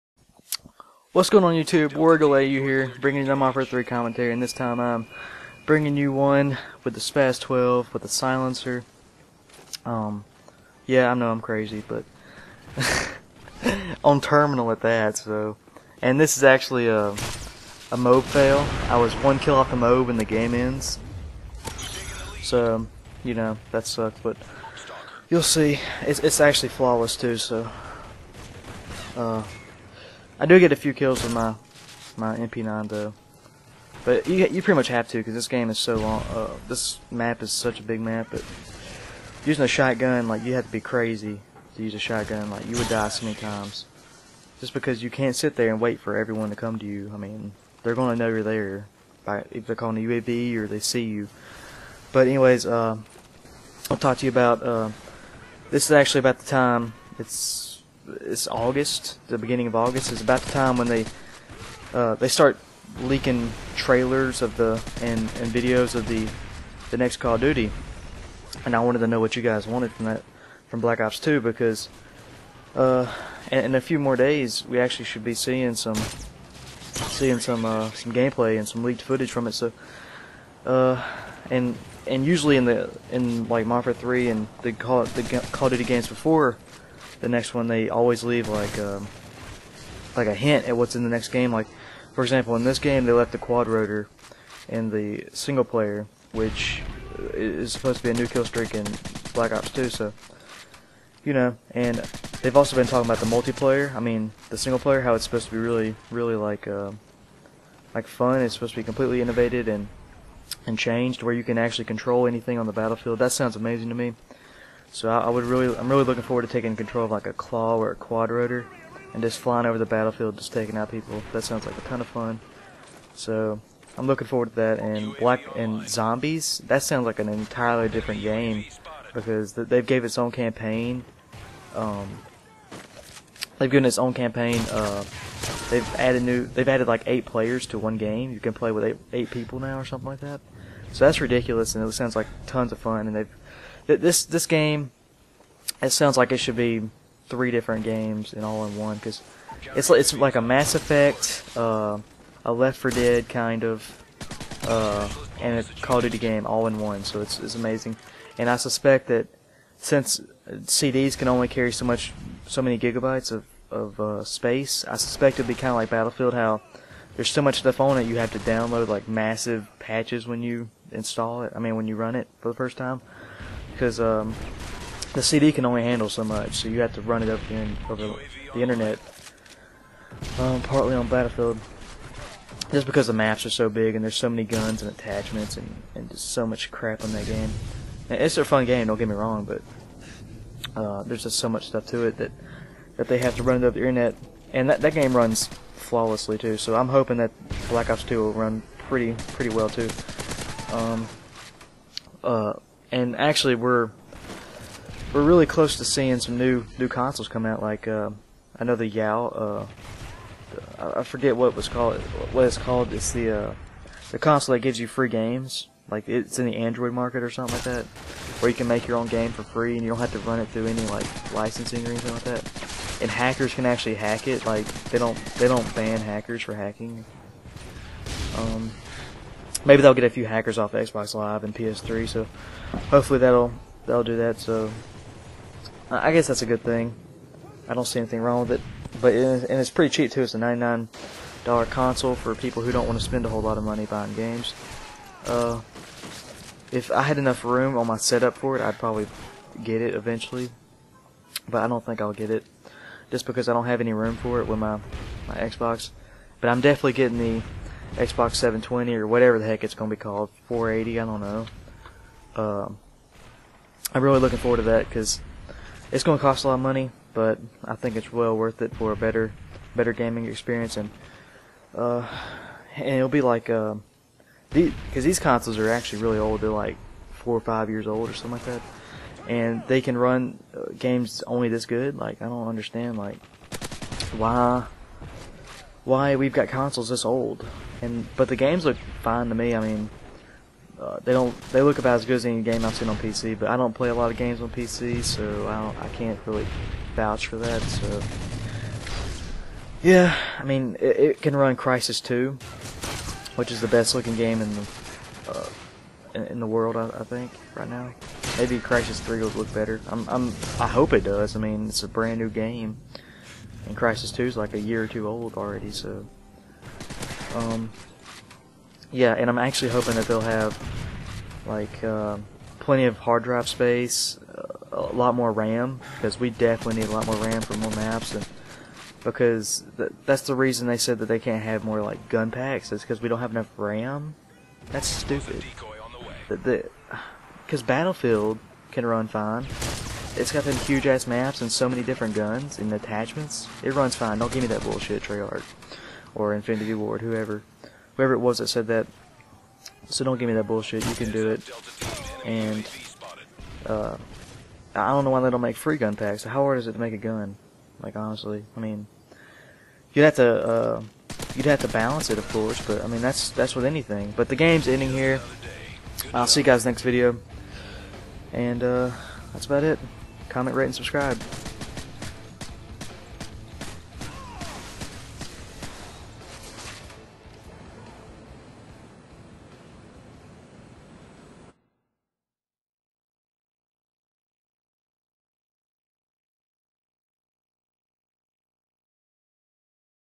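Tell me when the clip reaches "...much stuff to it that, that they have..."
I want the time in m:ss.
3:11.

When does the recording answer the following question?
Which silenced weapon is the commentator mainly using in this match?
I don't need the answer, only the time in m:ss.
0:07.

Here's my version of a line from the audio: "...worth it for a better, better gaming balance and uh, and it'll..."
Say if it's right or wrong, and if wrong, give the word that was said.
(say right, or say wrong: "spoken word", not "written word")
wrong: "experience", not "balance".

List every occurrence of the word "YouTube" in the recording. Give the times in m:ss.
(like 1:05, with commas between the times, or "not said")
0:01.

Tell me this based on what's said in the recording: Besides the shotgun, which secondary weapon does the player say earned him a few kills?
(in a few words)
MP9.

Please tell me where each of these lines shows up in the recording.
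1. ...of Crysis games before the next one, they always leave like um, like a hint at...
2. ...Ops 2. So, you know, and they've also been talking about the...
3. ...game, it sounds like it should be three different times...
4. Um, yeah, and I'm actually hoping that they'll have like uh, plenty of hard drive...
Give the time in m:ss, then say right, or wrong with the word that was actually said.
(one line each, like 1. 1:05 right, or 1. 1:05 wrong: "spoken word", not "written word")
1. 1:25 wrong: "Duty", not "Crysis"
2. 1:39 right
3. 2:24 wrong: "games", not "times"
4. 5:17 right.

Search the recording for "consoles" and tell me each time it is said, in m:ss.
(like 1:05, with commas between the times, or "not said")
3:26, 3:34, 4:01, 4:35, 4:46.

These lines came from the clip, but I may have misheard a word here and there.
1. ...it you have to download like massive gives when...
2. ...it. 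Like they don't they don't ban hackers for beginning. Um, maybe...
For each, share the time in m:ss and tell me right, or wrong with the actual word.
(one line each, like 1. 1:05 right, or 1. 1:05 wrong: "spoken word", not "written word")
1. 2:47 wrong: "patches", not "gives"
2. 3:44 wrong: "hacking", not "beginning".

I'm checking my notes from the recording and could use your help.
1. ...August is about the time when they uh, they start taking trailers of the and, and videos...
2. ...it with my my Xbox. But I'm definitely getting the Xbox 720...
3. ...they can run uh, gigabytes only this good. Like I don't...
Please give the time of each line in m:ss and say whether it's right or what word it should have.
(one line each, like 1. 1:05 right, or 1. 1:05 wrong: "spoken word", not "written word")
1. 0:59 wrong: "leaking", not "taking"
2. 4:14 right
3. 4:39 wrong: "games", not "gigabytes".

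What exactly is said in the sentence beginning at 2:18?
You can play with eight, eight people now or something like that.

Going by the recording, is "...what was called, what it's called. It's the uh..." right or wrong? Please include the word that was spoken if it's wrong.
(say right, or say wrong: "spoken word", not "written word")
right.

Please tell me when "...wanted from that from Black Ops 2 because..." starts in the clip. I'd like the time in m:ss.
1:09.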